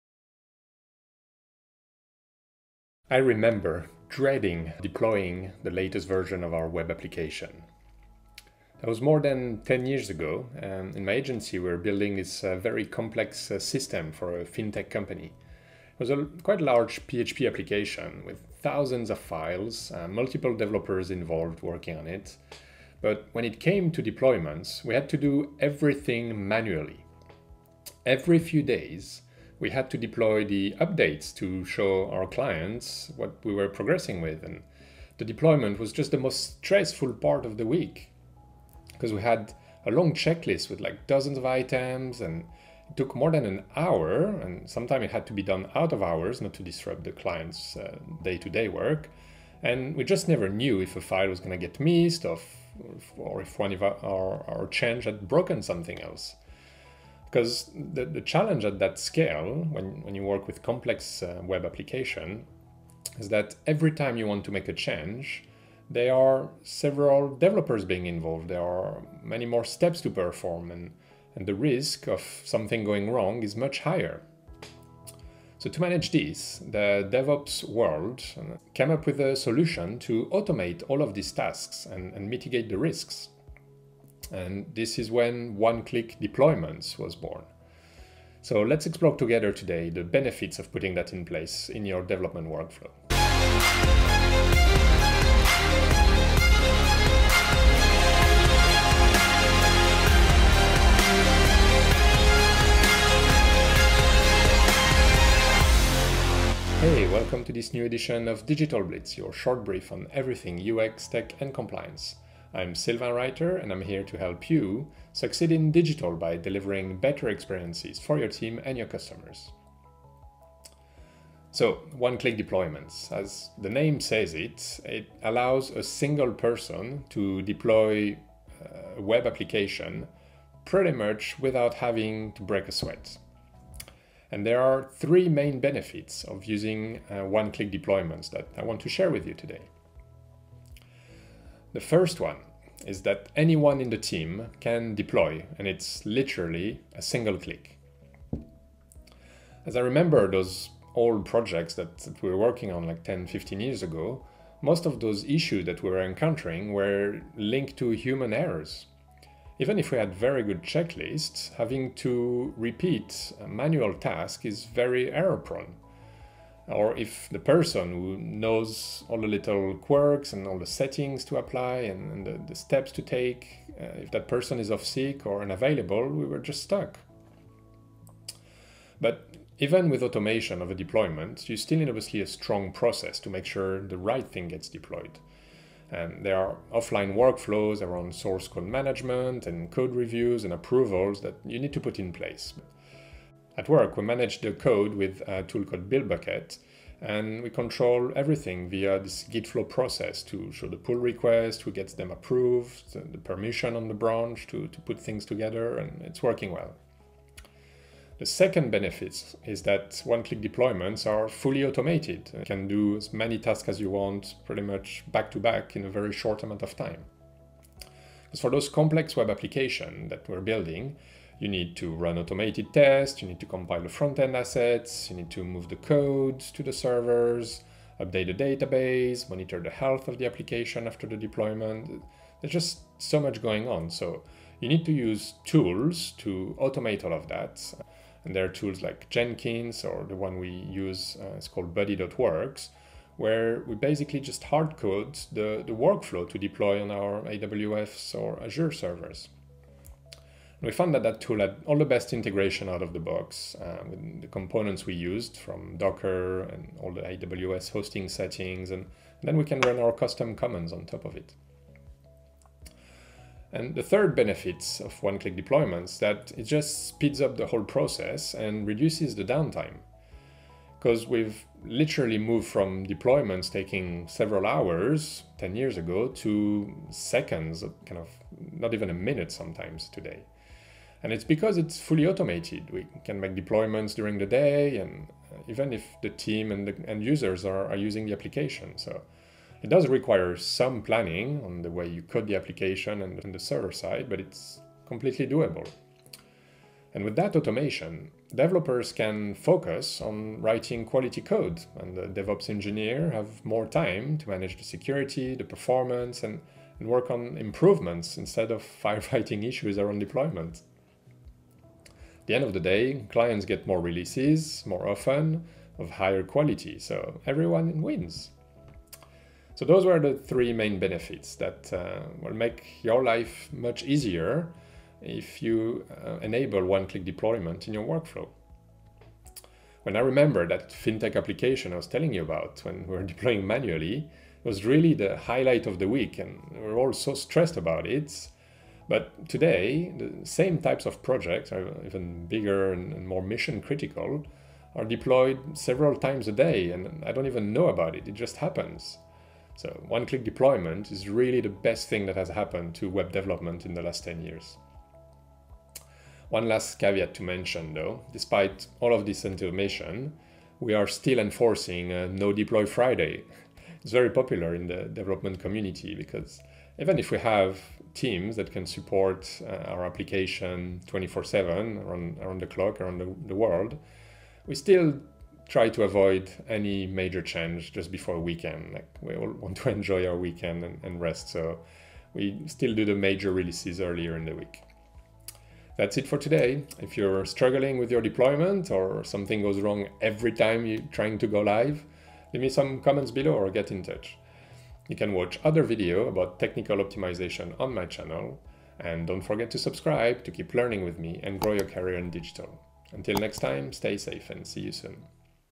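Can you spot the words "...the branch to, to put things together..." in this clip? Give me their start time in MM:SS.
03:23.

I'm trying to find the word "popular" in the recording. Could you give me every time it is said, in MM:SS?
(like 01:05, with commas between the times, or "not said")
06:04.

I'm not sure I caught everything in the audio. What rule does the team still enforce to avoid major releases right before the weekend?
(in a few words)
No Deploy Friday.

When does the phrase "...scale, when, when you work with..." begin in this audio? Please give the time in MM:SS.
00:58.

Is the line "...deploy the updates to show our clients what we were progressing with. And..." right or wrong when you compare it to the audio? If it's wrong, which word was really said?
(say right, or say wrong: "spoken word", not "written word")
right.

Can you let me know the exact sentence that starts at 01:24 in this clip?
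And this is when one-click deployments was born.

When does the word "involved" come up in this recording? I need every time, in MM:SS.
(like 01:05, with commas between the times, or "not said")
00:21, 01:08.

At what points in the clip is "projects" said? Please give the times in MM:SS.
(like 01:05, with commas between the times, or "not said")
02:31, 05:41.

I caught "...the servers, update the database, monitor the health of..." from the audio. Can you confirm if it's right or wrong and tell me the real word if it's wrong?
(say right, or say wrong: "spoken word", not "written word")
right.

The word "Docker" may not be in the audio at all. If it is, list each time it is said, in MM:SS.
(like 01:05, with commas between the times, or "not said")
04:15.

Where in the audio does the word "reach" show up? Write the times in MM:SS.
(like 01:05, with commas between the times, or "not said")
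not said.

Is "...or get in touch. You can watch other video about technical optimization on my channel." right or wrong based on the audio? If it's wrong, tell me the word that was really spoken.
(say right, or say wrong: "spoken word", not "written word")
right.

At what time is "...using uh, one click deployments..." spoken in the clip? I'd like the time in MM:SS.
02:16.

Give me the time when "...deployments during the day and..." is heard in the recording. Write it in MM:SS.
04:43.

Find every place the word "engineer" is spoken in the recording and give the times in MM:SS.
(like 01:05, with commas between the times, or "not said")
05:02.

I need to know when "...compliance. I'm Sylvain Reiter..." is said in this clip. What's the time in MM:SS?
01:51.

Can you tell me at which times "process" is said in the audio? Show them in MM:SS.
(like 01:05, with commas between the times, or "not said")
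03:02, 03:19, 04:27.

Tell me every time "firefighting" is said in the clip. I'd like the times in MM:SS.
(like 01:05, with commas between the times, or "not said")
05:08.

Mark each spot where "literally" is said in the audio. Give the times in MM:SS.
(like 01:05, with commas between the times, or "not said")
02:26, 04:31.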